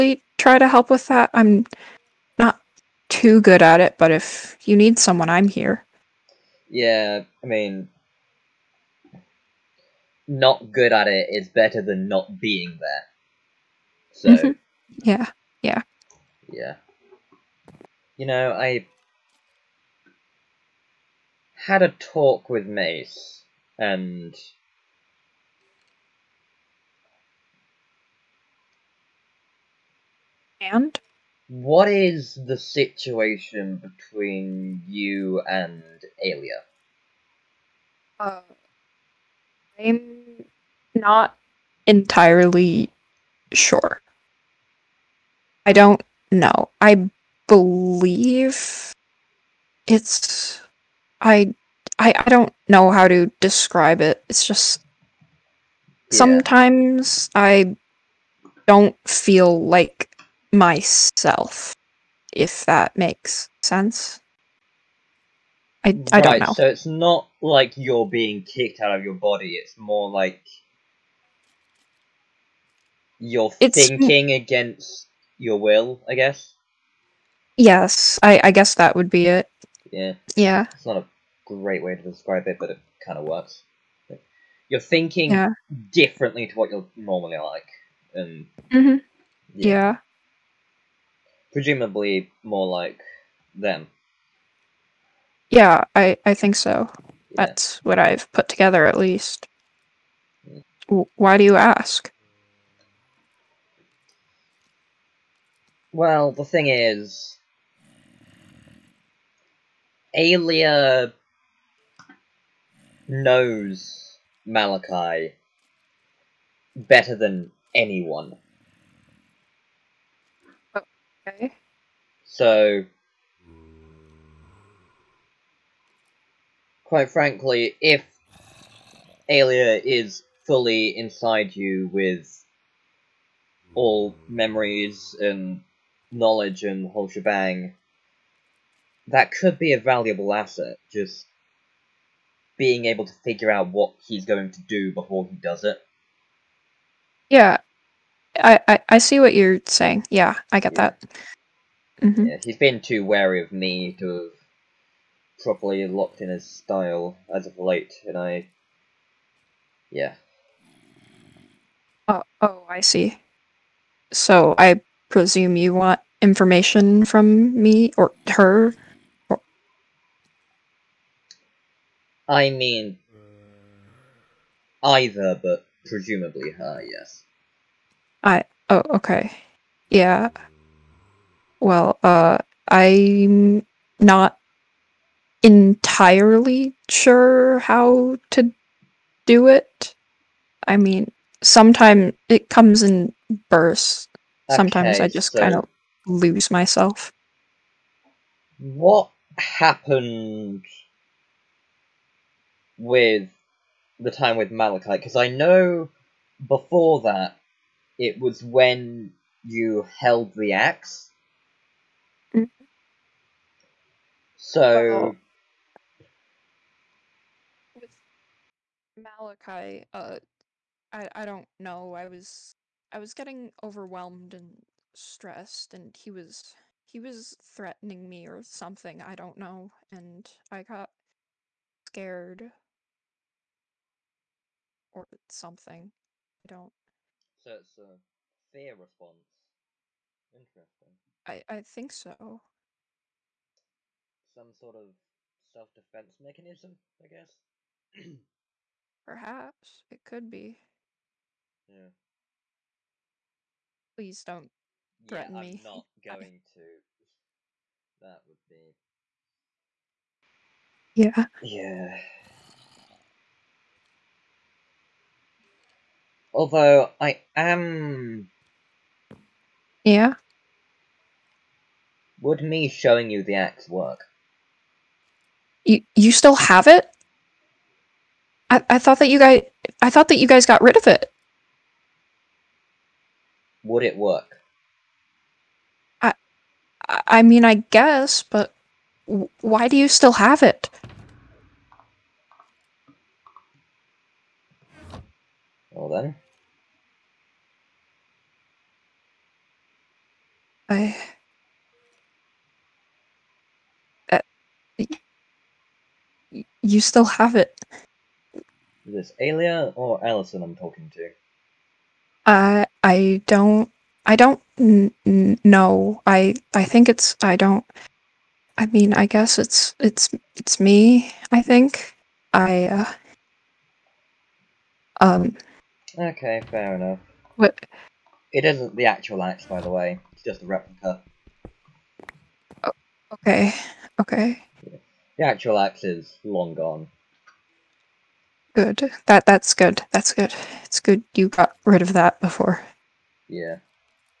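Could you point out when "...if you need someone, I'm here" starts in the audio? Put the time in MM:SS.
00:04.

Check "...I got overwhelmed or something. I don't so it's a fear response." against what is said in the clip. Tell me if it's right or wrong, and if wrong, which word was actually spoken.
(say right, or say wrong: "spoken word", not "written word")
wrong: "scared", not "overwhelmed".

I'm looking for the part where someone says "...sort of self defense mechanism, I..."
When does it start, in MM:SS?
04:04.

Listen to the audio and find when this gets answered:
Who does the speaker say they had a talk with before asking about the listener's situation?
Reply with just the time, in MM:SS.
00:22.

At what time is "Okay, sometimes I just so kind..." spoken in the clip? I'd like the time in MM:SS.
03:14.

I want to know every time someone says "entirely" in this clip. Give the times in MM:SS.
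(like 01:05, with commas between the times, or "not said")
00:41, 03:05.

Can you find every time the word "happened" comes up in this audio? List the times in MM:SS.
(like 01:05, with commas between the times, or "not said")
03:19.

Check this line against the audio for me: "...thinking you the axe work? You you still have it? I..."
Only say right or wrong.
wrong.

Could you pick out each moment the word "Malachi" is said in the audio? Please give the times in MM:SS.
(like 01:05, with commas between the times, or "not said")
01:54, 03:24, 03:38.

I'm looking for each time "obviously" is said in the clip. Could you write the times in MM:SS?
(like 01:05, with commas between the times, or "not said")
not said.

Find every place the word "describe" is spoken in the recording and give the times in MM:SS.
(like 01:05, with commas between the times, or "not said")
00:53, 01:22.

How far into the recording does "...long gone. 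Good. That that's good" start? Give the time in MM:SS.
05:36.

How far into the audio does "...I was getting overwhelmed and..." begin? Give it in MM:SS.
03:42.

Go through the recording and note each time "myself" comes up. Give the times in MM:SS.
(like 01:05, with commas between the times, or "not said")
01:00, 03:16.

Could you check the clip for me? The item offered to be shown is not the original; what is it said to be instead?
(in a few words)
A replica.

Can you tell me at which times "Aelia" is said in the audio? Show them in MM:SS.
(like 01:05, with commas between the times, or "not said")
00:36, 01:50, 02:09, 05:09.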